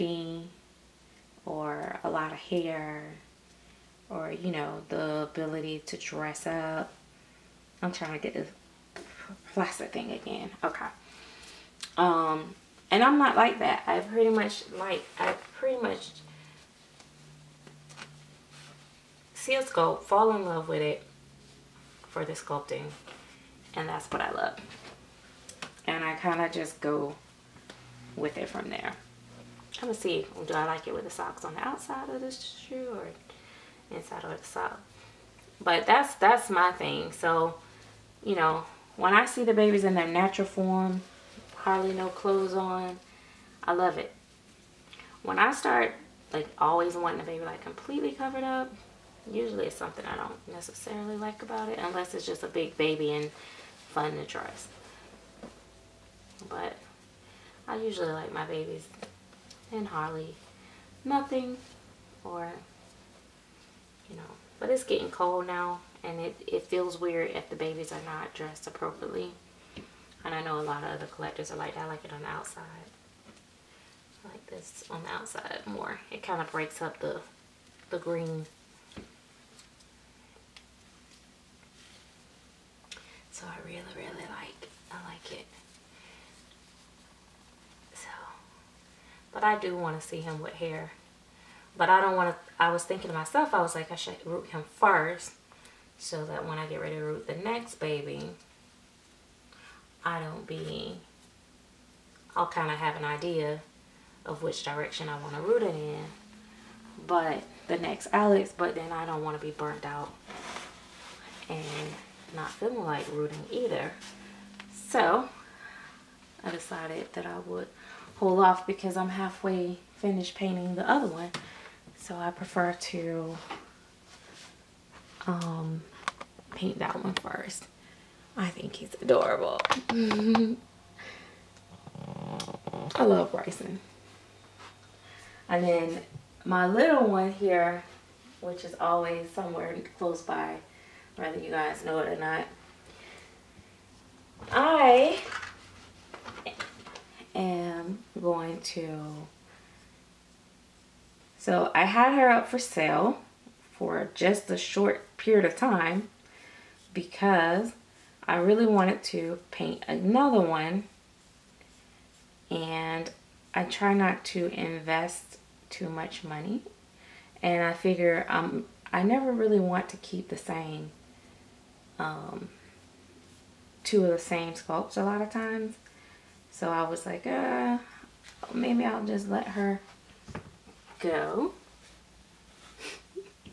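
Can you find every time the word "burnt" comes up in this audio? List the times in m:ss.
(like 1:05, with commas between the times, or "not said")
1:49.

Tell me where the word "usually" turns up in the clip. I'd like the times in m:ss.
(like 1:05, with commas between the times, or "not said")
0:49, 0:57.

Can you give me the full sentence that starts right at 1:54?
So I decided that I would hold off because I'm halfway finished painting the other one.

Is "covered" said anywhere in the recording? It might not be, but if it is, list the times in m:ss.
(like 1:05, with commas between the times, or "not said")
0:48.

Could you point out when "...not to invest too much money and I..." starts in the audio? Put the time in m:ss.
2:43.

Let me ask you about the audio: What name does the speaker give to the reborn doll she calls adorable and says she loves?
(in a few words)
Bryson.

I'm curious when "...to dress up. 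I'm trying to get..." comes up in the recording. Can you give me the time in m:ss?
0:05.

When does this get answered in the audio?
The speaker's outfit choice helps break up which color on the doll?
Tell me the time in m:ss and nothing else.
1:17.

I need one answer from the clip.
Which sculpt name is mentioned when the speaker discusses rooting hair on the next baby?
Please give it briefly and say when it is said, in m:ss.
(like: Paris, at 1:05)
Alex, at 1:48.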